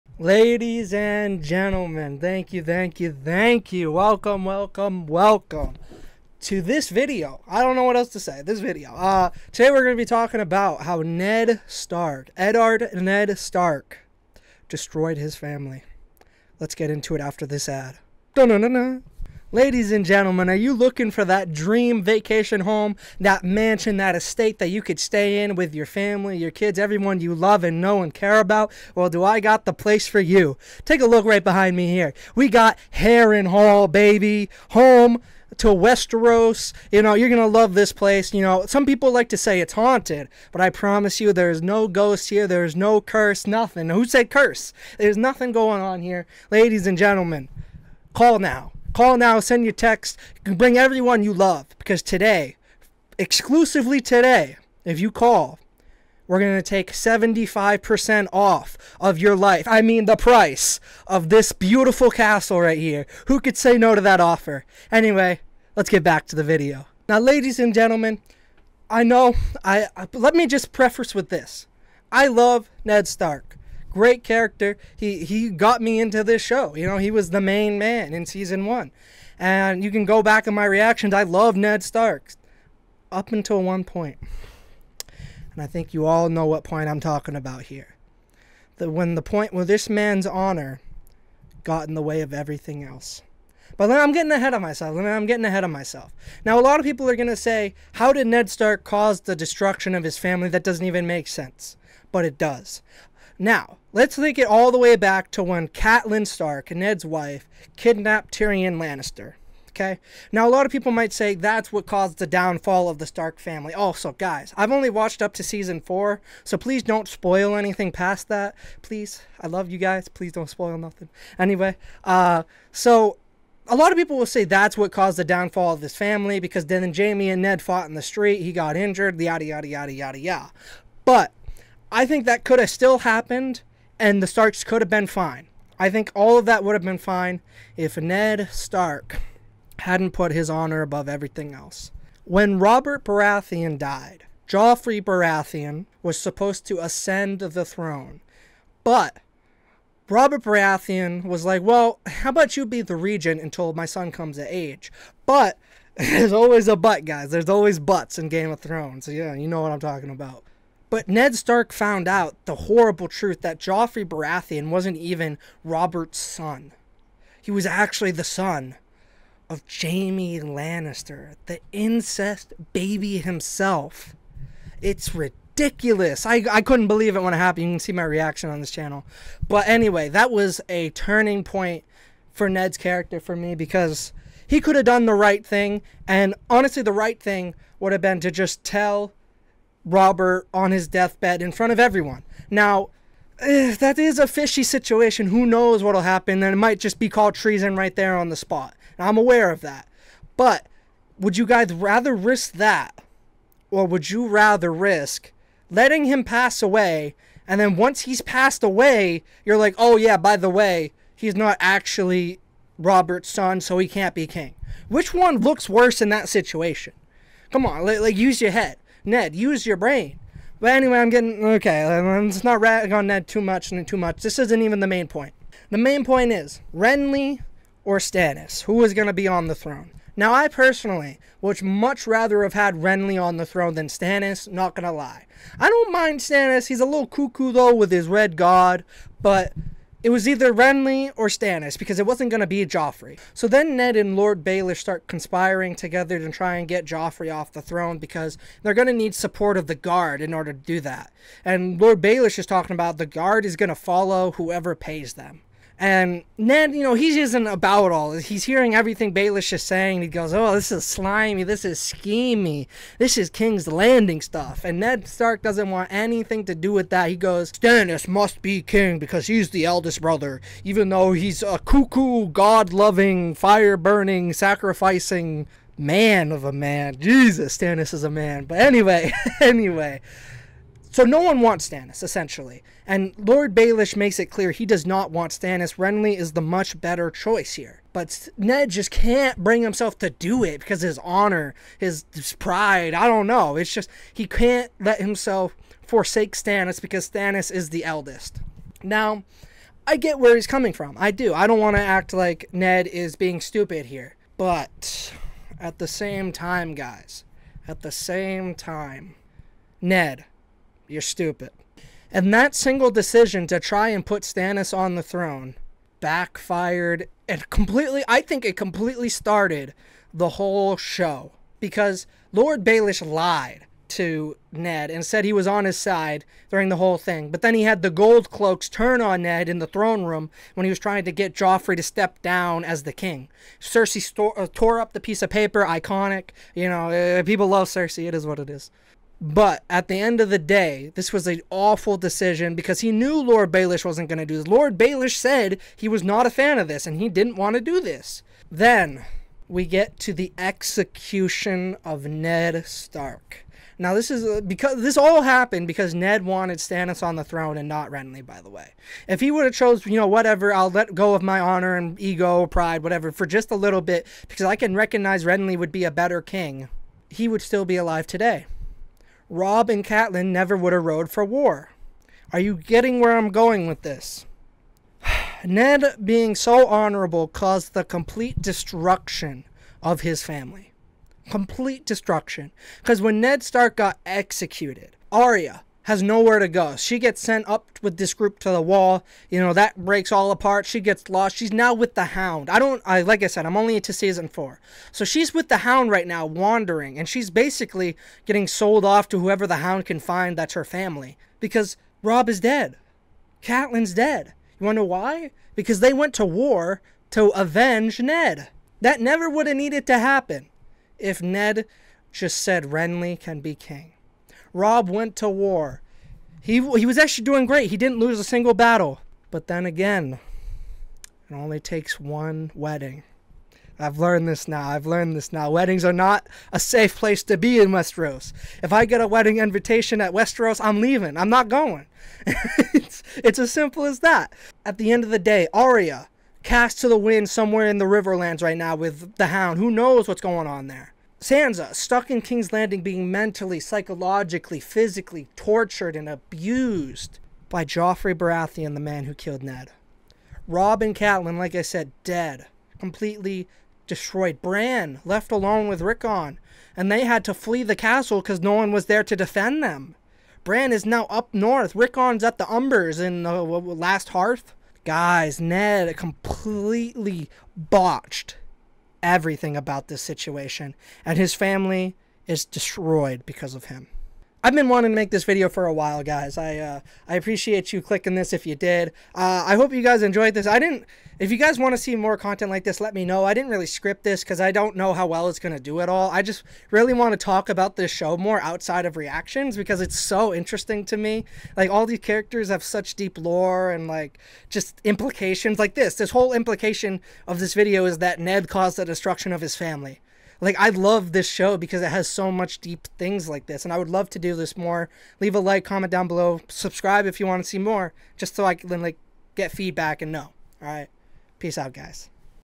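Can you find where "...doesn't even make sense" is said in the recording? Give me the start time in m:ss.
1:40.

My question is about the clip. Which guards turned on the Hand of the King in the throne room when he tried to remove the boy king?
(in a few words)
The gold cloaks.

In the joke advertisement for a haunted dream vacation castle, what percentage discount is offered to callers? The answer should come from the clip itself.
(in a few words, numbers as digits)
75%.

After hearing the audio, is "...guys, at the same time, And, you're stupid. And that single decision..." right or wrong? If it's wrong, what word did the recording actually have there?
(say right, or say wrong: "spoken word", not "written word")
wrong: "Ned", not "And".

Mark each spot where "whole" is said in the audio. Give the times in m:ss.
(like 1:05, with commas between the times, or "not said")
5:20, 5:26, 8:16.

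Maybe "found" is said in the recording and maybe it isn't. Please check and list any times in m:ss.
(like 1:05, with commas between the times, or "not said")
2:41.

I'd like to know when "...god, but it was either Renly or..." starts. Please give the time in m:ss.
3:58.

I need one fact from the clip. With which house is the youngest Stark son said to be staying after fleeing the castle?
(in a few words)
The Umbers.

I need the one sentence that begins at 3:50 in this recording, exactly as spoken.
Now, I personally would much rather have had Renly on the throne than Stannis, not gonna lie.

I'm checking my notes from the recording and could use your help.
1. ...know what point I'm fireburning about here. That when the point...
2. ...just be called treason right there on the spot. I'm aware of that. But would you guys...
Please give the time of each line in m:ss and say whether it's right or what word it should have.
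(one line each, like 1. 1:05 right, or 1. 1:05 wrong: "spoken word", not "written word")
1. 1:26 wrong: "talking", not "fireburning"
2. 3:16 right.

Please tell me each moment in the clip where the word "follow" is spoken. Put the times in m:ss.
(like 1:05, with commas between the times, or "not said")
4:13.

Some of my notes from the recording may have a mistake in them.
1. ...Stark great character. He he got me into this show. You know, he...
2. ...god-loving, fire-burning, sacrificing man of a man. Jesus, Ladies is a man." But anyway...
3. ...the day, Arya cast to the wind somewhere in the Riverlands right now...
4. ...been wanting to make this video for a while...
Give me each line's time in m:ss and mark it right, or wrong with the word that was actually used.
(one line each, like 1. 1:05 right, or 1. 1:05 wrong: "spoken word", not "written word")
1. 1:13 right
2. 4:32 wrong: "Stannis", not "Ladies"
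3. 7:15 right
4. 7:54 right.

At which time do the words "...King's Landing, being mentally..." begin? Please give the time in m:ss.
7:22.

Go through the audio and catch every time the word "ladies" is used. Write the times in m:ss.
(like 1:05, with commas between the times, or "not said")
0:00, 0:19, 0:46, 1:07.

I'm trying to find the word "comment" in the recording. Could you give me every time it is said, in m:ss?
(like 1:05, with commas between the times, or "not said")
8:25.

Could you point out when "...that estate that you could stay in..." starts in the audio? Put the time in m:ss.
0:23.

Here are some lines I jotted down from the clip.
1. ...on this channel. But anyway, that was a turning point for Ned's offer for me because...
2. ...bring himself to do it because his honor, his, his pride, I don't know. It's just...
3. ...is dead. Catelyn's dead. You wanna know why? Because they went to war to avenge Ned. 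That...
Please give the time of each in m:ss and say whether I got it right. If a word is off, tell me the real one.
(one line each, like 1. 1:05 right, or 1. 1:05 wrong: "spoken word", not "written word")
1. 2:58 wrong: "character", not "offer"
2. 4:49 right
3. 6:42 right.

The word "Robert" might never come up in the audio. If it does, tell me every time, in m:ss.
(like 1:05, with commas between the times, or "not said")
2:22, 2:30, 2:45, 3:09, 3:32.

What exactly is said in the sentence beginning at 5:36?
You know, uh, people love Cersei.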